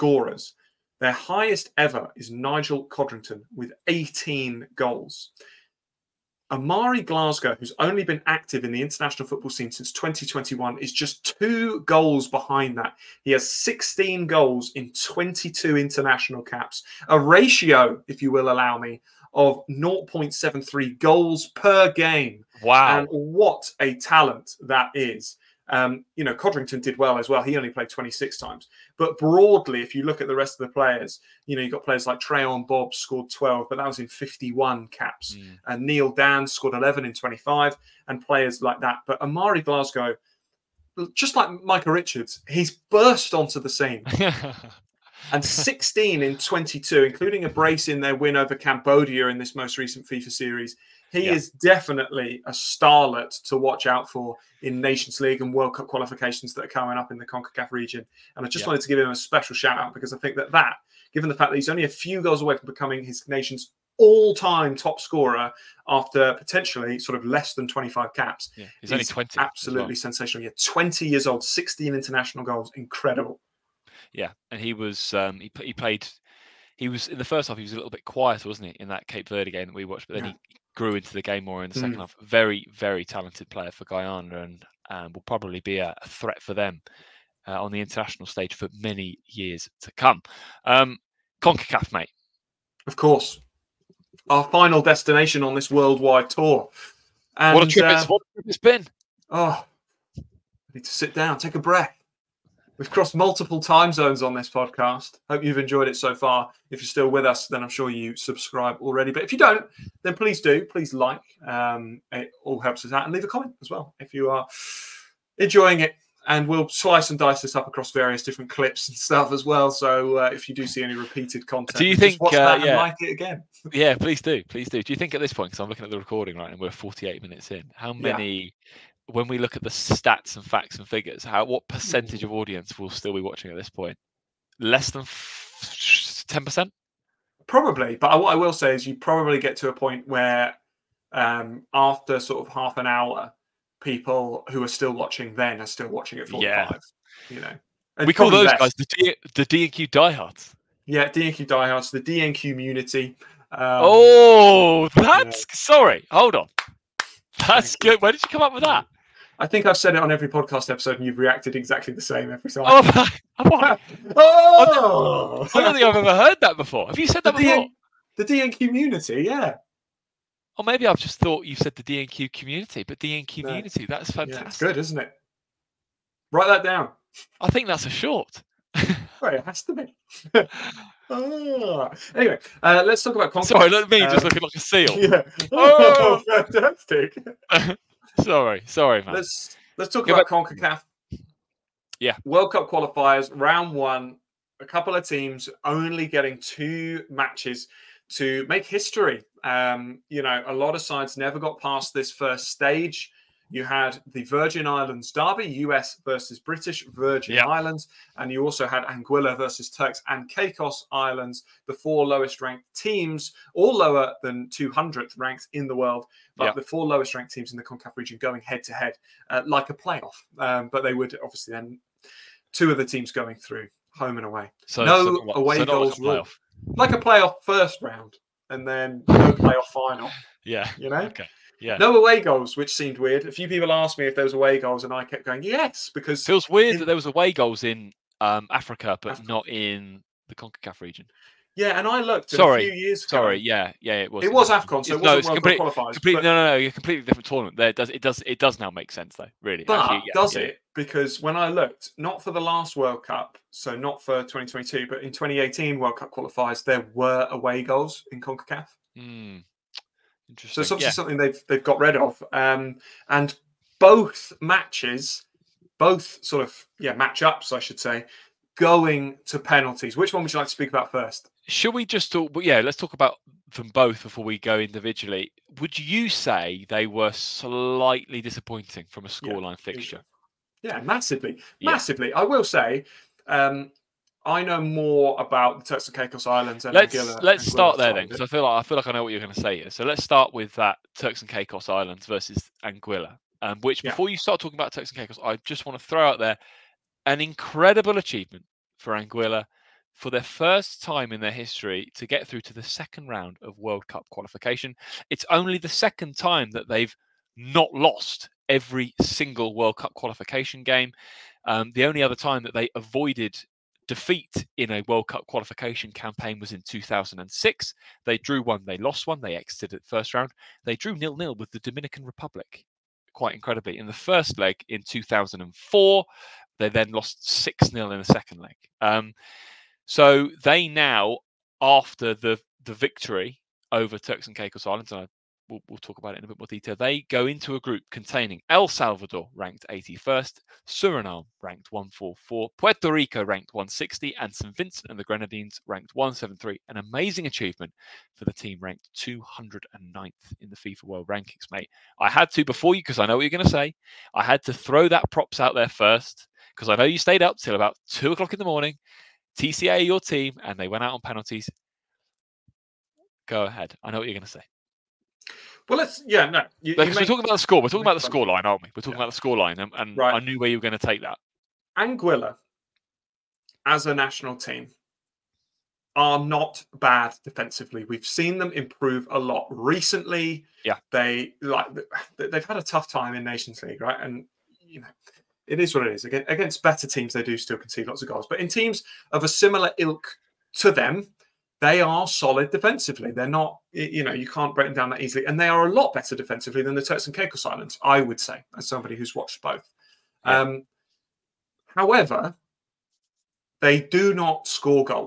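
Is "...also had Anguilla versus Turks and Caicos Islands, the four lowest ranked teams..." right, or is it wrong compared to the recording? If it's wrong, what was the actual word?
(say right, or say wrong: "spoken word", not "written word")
right.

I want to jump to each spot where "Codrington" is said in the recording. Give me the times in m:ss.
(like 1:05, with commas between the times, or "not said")
0:02, 0:26.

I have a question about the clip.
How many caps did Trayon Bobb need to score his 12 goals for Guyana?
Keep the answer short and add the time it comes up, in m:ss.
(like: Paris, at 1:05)
51, at 0:34.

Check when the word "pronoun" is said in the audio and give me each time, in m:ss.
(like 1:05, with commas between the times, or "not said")
not said.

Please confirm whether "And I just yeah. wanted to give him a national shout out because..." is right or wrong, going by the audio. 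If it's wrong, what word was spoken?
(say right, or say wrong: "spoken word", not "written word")
wrong: "special", not "national".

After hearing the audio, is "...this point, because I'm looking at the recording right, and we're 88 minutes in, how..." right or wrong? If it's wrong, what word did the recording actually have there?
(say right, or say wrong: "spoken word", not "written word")
wrong: "48", not "88".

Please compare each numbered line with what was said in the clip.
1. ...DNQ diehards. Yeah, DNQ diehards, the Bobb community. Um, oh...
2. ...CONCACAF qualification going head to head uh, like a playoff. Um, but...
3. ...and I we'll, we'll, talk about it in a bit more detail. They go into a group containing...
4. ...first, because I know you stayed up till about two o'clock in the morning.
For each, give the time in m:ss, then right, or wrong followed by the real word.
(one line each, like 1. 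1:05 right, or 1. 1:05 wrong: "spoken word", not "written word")
1. 2:29 wrong: "DNQ", not "Bobb"
2. 3:37 wrong: "region", not "qualification"
3. 5:34 right
4. 5:55 right.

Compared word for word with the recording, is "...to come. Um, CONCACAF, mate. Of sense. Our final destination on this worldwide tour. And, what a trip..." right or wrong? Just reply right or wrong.
wrong.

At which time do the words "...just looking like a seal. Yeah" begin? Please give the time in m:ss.
3:04.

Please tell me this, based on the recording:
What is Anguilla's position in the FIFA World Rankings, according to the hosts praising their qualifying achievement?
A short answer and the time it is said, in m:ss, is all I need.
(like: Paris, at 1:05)
209th, at 5:48.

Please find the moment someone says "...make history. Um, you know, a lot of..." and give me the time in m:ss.
3:18.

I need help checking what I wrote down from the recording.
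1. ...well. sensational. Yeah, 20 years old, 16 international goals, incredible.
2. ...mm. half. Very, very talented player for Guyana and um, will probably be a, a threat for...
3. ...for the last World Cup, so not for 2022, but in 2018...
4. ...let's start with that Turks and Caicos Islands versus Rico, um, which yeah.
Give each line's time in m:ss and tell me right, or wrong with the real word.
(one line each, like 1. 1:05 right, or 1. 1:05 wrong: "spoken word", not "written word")
1. 1:09 right
2. 1:21 right
3. 4:12 right
4. 4:49 wrong: "Anguilla", not "Rico".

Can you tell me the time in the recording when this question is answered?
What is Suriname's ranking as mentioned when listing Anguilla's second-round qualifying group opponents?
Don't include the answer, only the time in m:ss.
5:41.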